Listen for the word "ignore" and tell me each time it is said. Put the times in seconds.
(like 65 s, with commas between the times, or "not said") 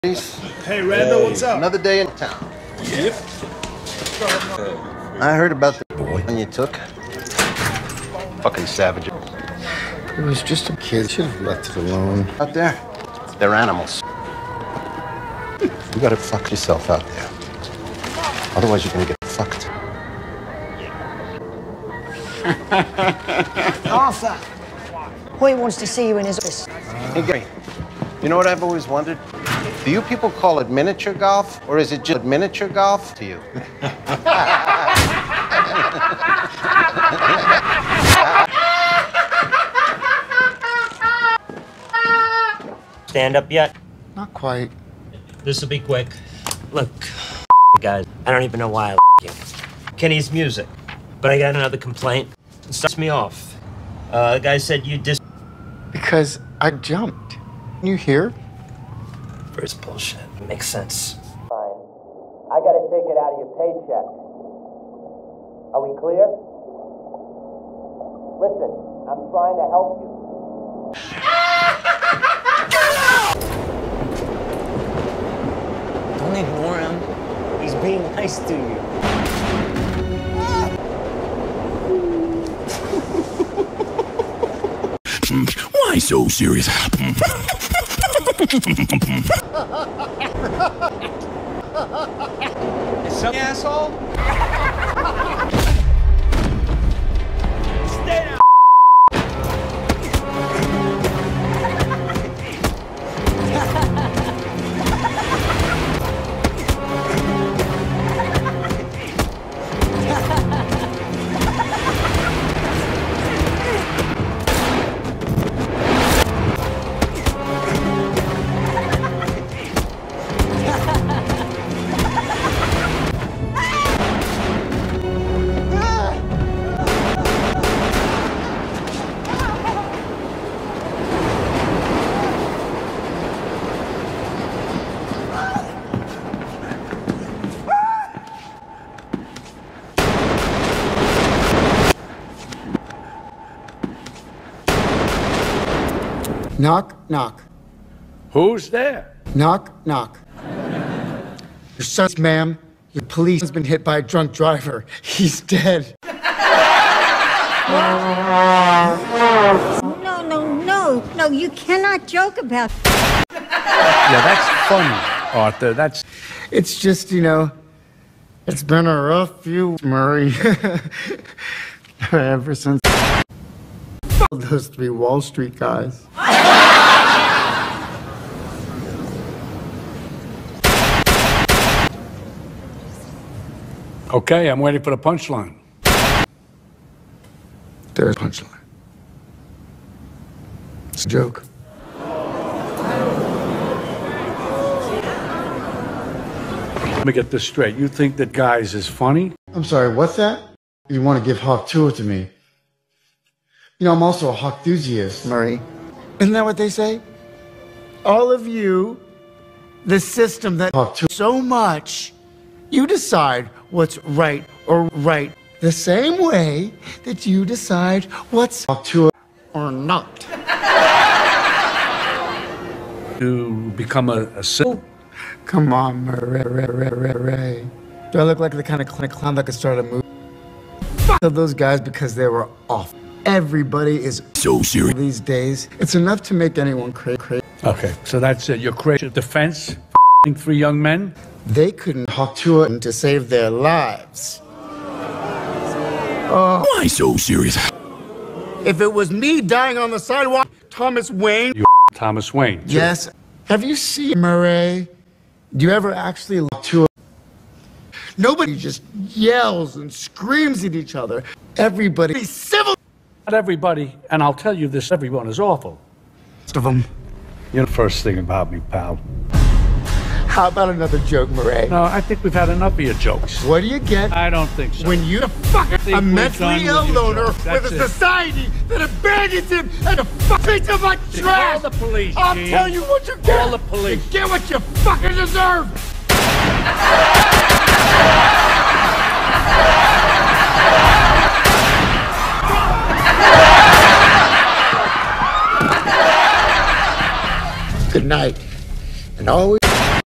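76 s.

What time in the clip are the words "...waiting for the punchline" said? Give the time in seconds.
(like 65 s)
184 s.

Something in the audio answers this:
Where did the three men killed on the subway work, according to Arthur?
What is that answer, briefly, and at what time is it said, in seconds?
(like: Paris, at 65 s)
Wall Street, at 174 s.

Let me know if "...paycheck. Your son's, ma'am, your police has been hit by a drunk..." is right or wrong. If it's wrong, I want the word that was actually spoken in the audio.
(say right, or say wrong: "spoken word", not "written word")
wrong: "knock", not "paycheck".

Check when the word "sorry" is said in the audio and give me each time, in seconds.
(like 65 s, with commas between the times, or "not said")
199 s.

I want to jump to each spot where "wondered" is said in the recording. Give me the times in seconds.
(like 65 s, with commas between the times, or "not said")
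28 s.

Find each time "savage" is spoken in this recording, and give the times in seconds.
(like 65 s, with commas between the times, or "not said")
8 s.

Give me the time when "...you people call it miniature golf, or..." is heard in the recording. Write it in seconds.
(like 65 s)
29 s.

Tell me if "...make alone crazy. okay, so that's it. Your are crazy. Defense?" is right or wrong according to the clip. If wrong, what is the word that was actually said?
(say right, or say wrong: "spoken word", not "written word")
wrong: "anyone", not "alone".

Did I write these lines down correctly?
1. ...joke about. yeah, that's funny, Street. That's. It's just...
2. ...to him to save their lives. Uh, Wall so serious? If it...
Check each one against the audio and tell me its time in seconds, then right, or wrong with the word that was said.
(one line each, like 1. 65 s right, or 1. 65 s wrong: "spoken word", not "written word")
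1. 162 s wrong: "Arthur", not "Street"
2. 242 s wrong: "Why", not "Wall".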